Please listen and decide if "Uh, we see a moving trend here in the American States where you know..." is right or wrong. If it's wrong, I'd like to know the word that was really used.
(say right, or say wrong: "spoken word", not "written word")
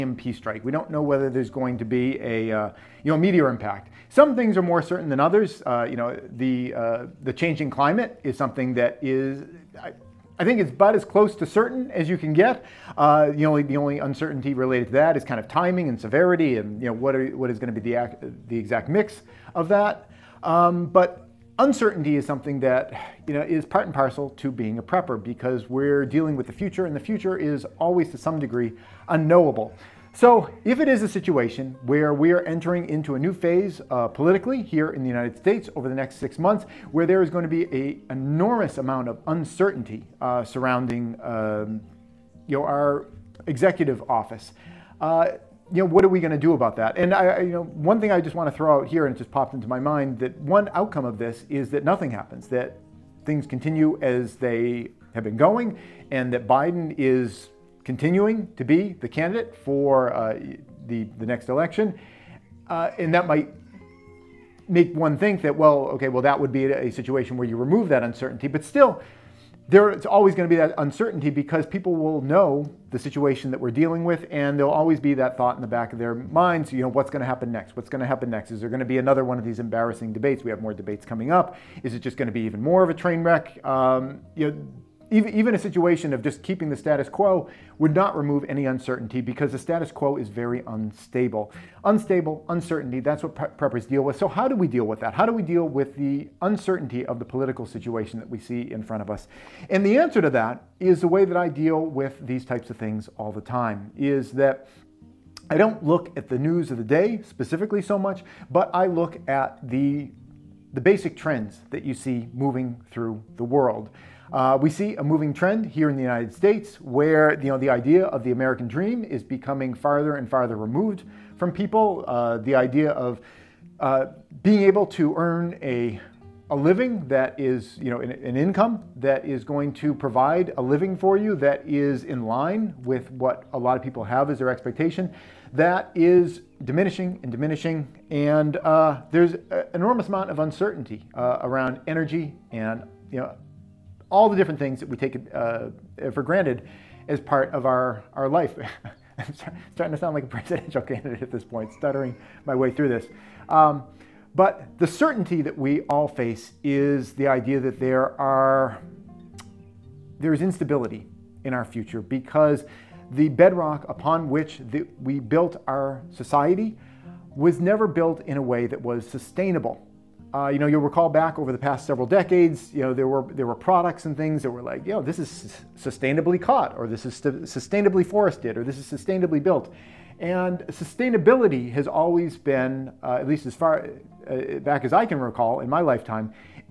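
wrong: "United", not "American".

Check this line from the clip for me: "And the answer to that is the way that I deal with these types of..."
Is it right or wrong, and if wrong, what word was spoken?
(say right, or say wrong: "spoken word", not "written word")
right.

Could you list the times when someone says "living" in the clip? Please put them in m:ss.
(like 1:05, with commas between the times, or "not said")
2:06, 2:10.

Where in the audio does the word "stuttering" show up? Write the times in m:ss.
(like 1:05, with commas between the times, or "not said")
2:31.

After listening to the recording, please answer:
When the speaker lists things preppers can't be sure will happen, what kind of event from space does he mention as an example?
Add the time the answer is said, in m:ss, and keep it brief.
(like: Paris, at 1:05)
meteor impact, at 0:03.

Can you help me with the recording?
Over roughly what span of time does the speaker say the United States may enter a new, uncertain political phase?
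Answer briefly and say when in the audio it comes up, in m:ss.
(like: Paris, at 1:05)
6 months, at 0:36.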